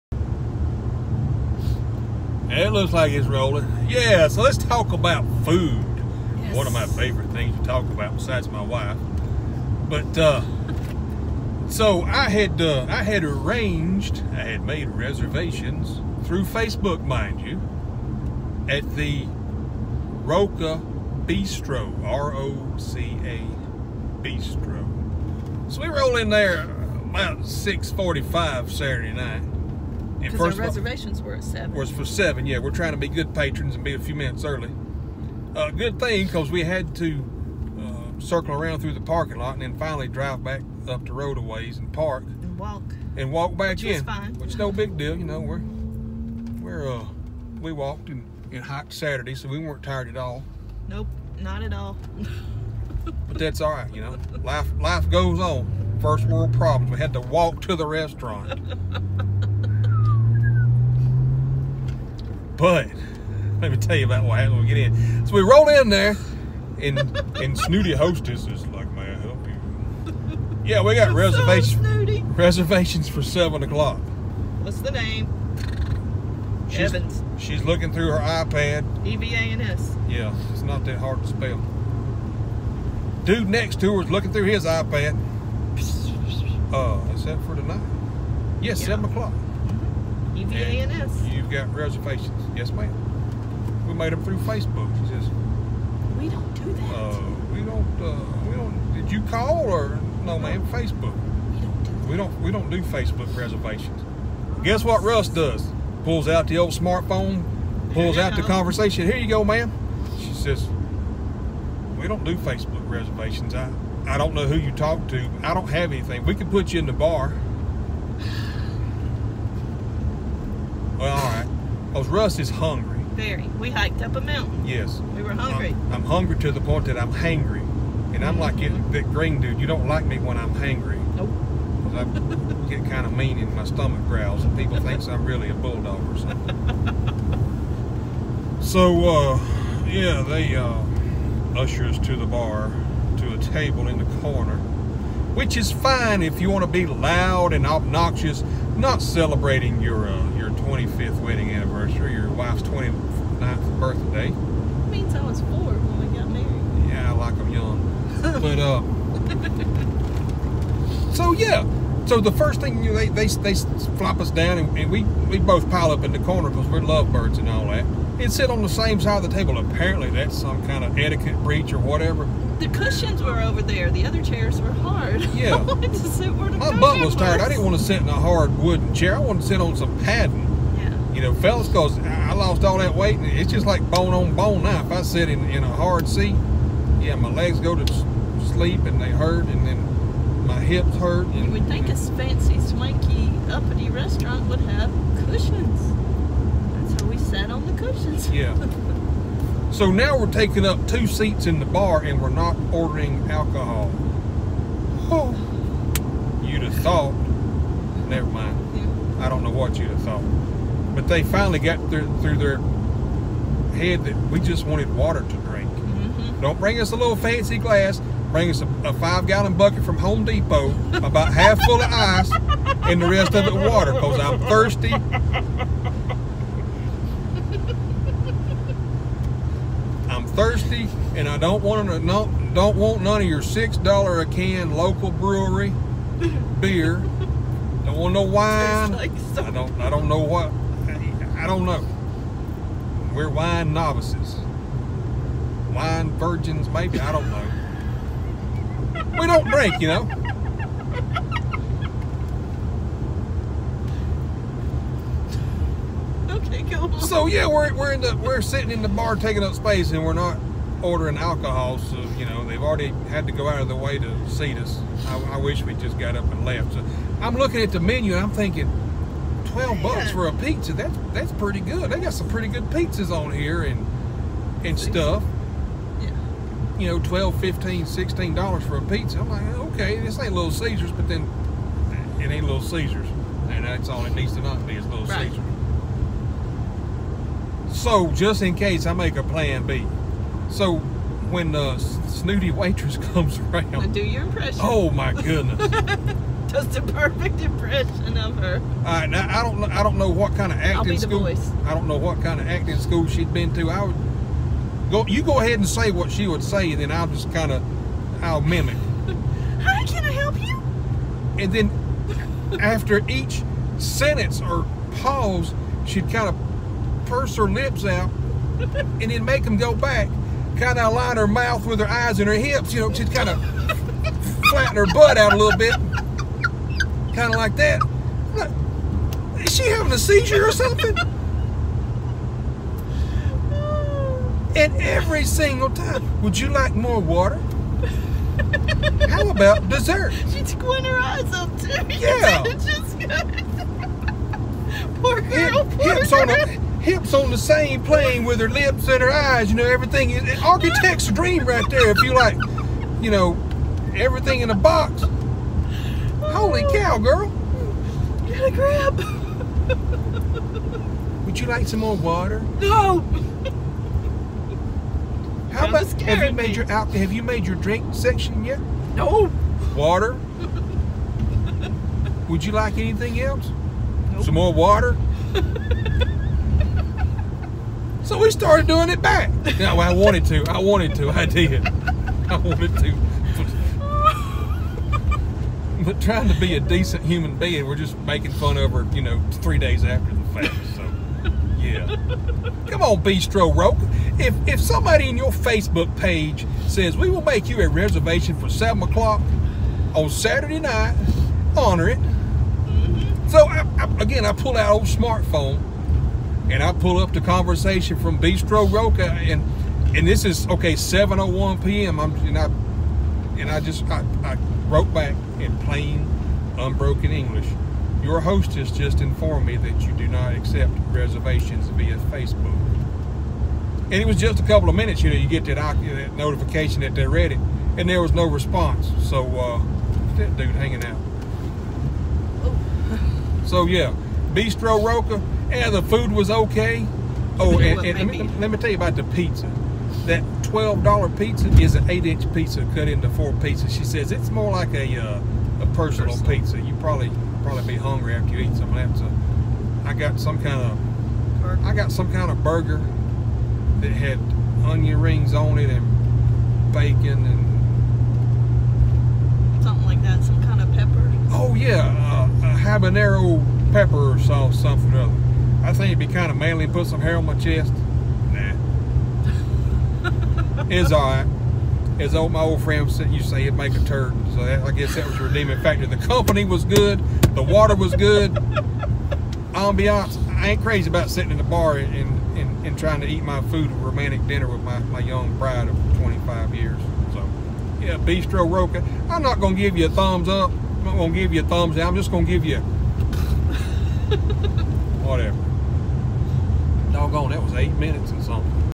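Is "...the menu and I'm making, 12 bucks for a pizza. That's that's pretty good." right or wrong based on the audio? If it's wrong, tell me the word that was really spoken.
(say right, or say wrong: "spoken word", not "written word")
wrong: "thinking", not "making".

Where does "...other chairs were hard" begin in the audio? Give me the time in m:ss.
2:54.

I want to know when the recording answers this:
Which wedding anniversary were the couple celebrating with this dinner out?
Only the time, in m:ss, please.
2:30.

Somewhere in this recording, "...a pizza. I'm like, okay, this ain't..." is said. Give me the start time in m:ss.
4:38.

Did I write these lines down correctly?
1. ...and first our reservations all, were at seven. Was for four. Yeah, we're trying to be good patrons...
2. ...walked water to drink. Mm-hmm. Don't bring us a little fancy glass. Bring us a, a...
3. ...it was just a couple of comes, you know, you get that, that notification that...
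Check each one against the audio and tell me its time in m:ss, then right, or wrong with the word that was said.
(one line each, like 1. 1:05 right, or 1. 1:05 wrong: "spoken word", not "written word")
1. 0:30 wrong: "seven", not "four"
2. 3:34 wrong: "wanted", not "walked"
3. 7:03 wrong: "minutes", not "comes".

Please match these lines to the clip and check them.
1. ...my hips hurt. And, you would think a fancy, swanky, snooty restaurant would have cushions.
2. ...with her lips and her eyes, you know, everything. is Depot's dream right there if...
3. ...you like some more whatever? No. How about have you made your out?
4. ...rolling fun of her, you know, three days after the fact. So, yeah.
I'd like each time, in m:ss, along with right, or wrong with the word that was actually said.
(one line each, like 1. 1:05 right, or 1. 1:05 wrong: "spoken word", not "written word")
1. 3:10 wrong: "uppity", not "snooty"
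2. 5:48 wrong: "Architect", not "Depot"
3. 6:01 wrong: "water", not "whatever"
4. 6:27 wrong: "making", not "rolling".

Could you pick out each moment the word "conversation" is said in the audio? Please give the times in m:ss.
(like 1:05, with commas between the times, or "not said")
1:48, 6:47.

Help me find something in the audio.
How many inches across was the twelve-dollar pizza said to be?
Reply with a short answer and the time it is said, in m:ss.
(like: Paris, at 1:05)
8 inches, at 7:21.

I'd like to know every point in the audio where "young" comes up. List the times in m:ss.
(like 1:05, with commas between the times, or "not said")
2:37, 8:04.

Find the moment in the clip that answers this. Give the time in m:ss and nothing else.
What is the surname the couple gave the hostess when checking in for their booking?
1:16.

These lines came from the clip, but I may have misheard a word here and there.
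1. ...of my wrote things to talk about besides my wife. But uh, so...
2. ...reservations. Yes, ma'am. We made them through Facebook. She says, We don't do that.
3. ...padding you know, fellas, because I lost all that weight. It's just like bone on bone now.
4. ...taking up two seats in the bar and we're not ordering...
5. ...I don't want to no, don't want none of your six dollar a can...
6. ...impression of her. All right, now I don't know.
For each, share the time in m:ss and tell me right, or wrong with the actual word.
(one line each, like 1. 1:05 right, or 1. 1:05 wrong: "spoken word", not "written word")
1. 0:06 wrong: "favorite", not "wrote"
2. 1:31 right
3. 3:00 right
4. 3:20 right
5. 3:51 right
6. 4:57 right.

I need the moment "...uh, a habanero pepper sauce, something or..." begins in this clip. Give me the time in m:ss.
7:42.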